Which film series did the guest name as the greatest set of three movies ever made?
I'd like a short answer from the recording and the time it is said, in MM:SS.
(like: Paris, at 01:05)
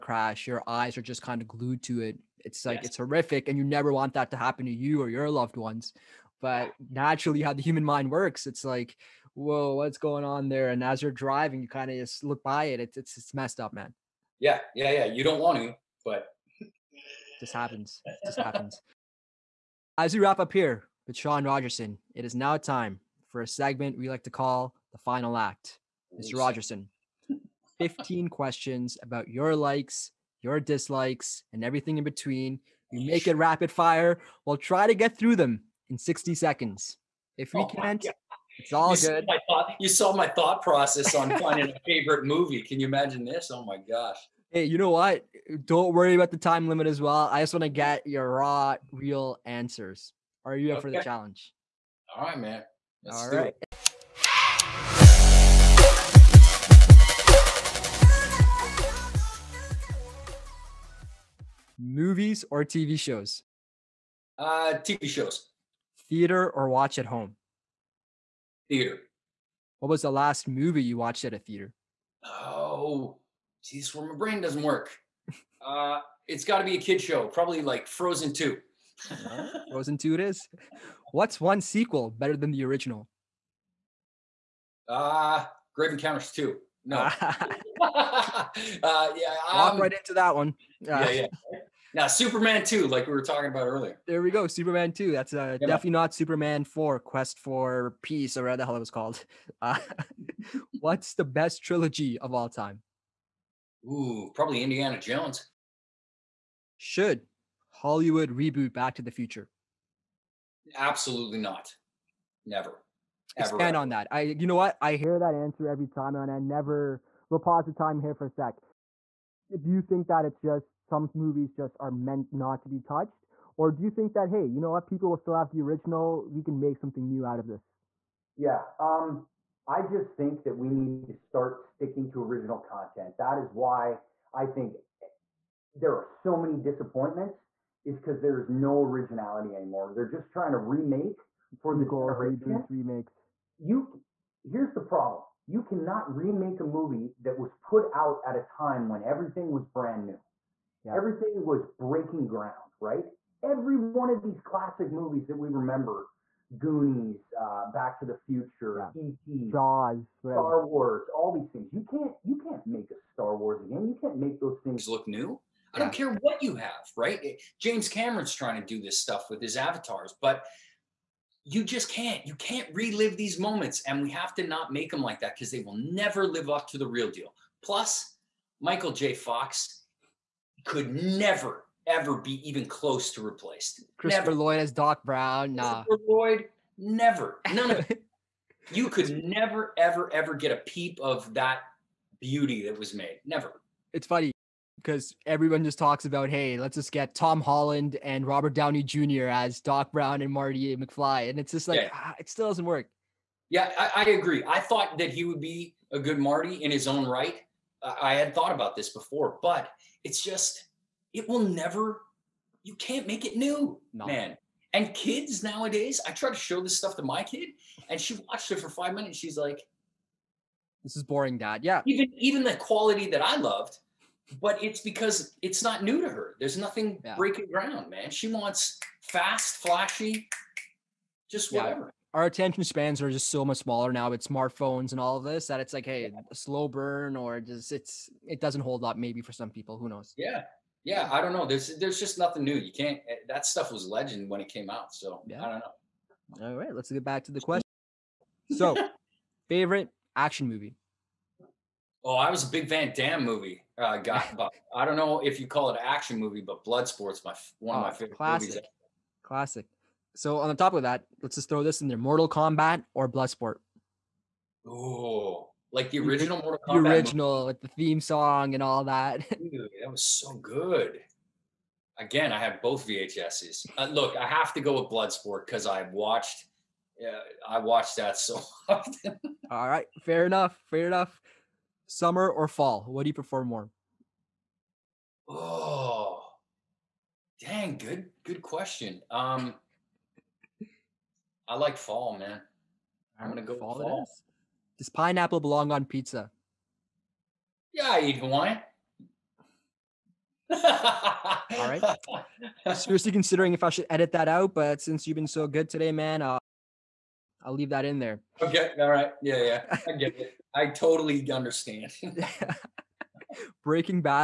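Indiana Jones, at 01:44.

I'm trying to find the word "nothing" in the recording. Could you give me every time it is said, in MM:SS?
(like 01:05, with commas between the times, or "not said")
03:46, 04:02.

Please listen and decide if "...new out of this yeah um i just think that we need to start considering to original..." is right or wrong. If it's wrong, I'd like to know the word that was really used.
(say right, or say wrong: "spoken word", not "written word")
wrong: "sticking", not "considering".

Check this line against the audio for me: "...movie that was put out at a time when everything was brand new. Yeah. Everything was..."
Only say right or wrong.
right.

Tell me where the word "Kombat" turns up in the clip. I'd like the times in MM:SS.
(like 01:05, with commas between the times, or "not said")
04:22, 04:26.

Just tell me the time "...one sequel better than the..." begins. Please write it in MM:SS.
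01:21.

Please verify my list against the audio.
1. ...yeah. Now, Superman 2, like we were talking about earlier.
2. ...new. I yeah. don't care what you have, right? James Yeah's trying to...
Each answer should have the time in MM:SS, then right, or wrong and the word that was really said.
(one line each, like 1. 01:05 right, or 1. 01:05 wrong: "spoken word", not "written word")
1. 01:31 right
2. 02:45 wrong: "Cameron", not "Yeah".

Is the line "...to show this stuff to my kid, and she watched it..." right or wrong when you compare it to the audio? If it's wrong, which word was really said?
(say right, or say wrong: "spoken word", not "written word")
right.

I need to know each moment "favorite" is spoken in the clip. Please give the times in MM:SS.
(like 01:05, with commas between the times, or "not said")
00:41, 04:09, 04:17.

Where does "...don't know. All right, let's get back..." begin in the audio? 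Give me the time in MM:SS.
04:05.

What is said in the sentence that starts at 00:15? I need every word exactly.
You don't want to, but this happens.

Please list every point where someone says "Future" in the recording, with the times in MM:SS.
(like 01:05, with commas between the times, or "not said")
01:49, 02:38.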